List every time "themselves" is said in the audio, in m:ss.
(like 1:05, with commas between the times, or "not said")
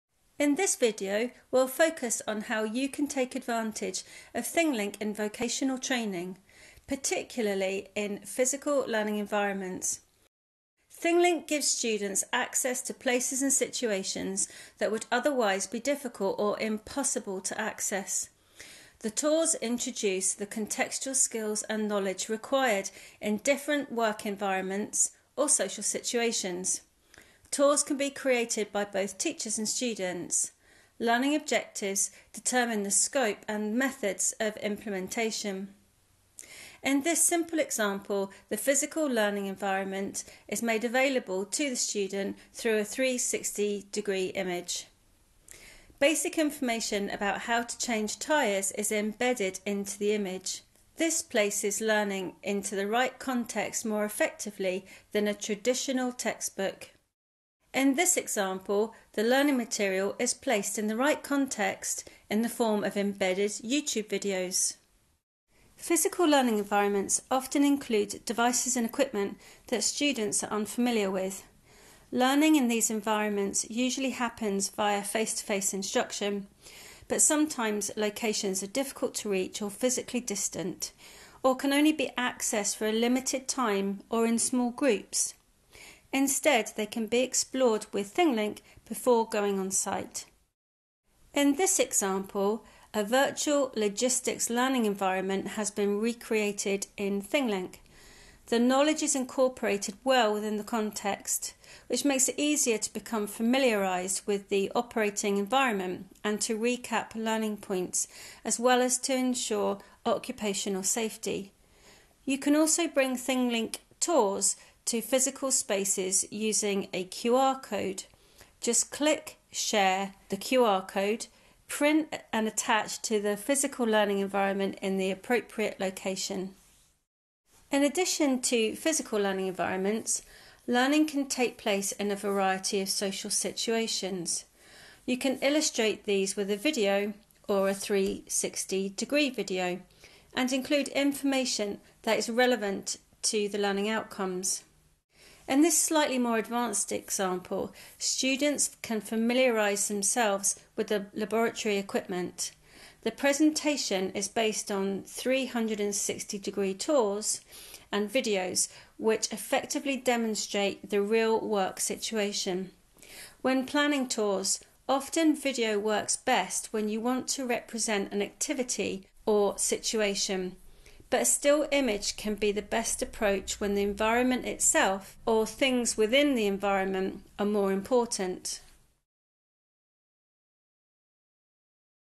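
2:29.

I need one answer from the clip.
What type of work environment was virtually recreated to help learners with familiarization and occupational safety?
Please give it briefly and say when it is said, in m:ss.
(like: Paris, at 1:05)
logistics, at 1:33.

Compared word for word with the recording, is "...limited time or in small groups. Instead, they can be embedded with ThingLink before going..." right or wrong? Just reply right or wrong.
wrong.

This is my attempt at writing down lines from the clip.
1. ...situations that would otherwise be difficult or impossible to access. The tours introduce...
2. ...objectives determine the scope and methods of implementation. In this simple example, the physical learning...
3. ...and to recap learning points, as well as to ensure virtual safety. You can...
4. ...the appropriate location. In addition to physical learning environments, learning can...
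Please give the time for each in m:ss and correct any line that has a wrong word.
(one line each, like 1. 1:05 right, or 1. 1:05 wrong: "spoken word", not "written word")
1. 0:13 right
2. 0:31 right
3. 1:46 wrong: "occupational", not "virtual"
4. 2:04 right.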